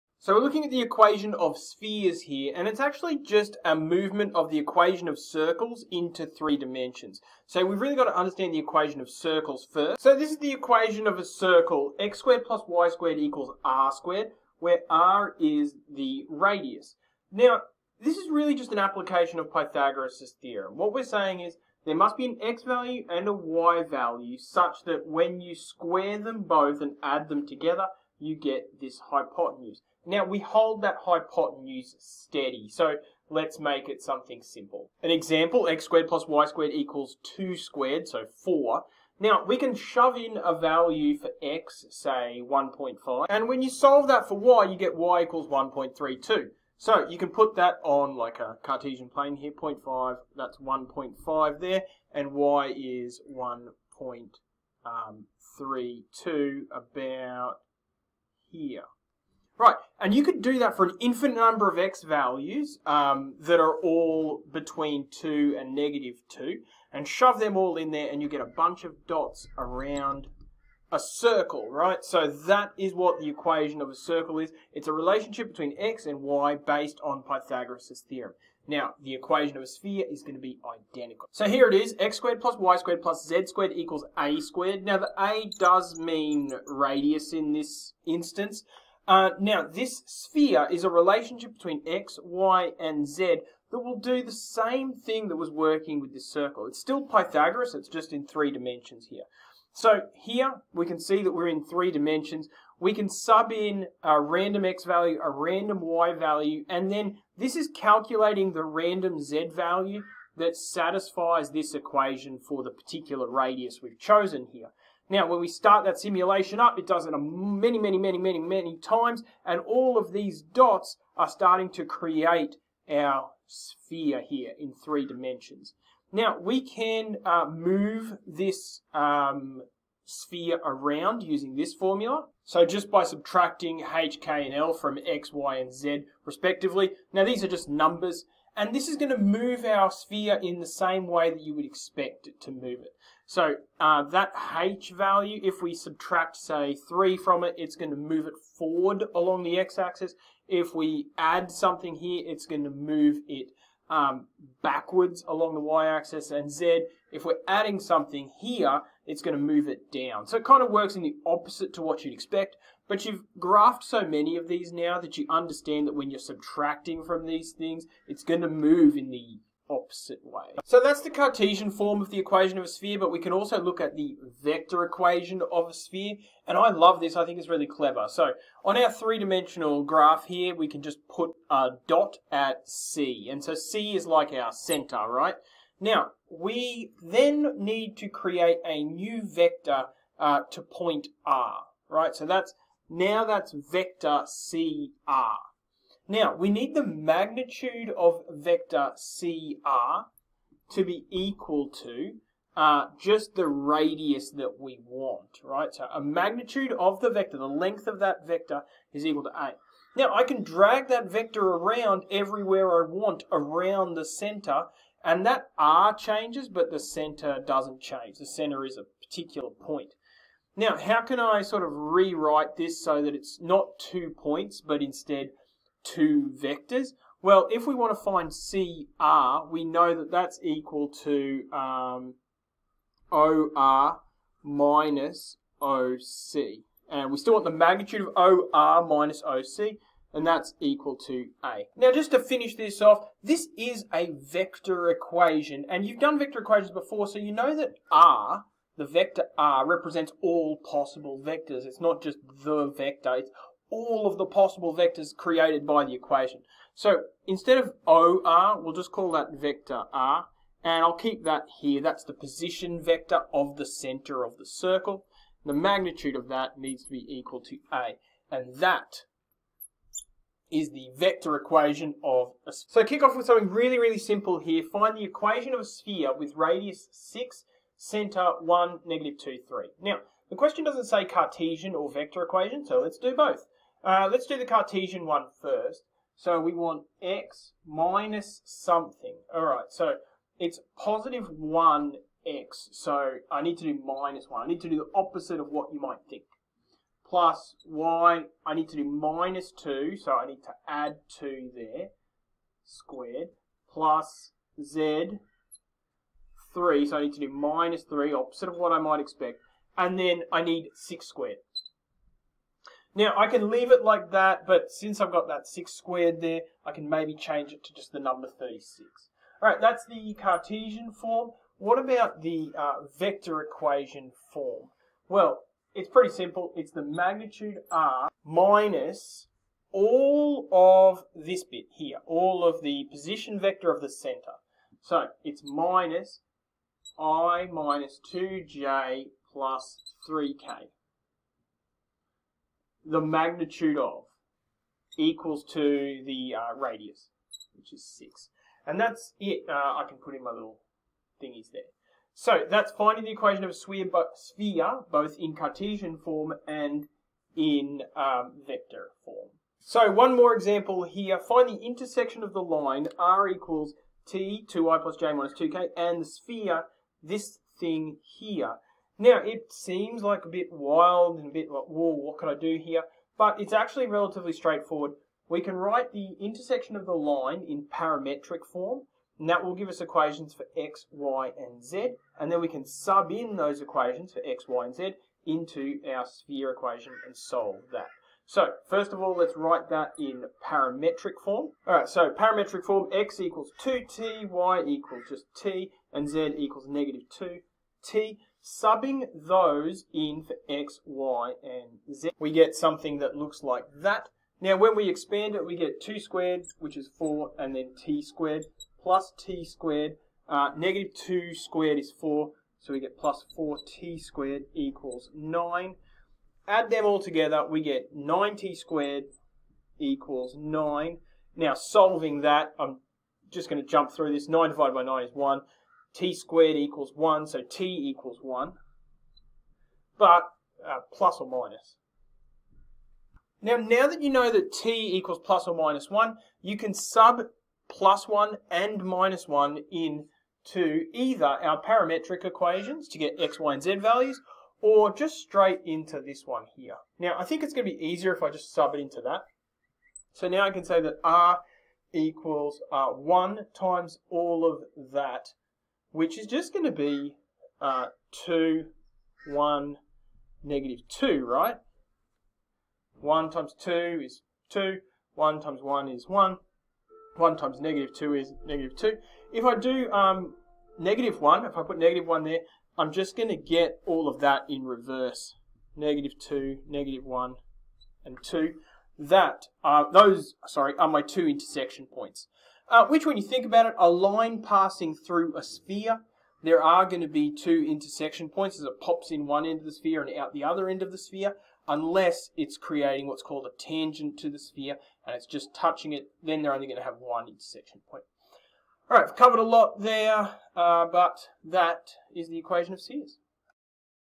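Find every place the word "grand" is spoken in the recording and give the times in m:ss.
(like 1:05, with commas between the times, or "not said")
not said.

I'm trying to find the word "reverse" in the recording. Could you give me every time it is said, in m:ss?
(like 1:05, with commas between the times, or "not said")
7:54.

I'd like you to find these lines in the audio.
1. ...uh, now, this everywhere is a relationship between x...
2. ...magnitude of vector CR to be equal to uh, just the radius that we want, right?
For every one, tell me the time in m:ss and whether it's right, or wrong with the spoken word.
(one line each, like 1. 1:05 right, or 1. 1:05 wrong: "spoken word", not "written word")
1. 1:29 wrong: "sphere", not "everywhere"
2. 3:16 right.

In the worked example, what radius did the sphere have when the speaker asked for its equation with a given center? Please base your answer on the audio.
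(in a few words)
6.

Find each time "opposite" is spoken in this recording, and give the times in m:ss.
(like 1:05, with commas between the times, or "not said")
2:41, 2:49, 4:54, 5:08.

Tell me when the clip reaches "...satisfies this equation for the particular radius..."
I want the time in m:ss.
1:50.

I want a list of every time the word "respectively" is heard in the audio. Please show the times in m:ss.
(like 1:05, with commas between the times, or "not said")
2:16.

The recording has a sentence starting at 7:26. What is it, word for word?
Now, I think it's going to be easier if I just sub it into that.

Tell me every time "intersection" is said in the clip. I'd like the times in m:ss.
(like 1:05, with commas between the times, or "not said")
6:01, 6:16, 8:01, 8:07, 8:17.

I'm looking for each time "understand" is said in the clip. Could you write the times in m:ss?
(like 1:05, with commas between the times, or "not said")
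0:08, 2:45.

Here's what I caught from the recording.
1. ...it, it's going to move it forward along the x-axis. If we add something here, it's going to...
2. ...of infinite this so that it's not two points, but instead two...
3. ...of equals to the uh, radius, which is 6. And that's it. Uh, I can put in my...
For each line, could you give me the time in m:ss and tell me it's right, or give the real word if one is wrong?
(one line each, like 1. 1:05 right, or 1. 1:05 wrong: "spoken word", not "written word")
1. 2:27 right
2. 3:41 wrong: "rewrite", not "infinite"
3. 5:43 right.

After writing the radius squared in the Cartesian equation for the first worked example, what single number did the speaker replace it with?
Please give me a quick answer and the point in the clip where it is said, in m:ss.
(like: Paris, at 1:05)
36, at 5:17.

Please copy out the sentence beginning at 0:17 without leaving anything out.
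Now, this is really just an application of Pythagoras' theorem.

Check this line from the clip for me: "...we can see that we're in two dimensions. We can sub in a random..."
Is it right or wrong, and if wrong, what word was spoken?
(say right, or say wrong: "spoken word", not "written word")
wrong: "three", not "two".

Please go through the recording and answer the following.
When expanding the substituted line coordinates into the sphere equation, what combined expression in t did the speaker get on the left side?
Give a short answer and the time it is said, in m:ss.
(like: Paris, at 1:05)
9t squared, at 6:57.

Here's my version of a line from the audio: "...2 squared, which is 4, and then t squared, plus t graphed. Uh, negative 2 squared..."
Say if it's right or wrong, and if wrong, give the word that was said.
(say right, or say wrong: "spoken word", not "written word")
wrong: "squared", not "graphed".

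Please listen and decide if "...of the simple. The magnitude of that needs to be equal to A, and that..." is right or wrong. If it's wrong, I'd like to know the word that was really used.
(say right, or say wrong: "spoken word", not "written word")
wrong: "circle", not "simple".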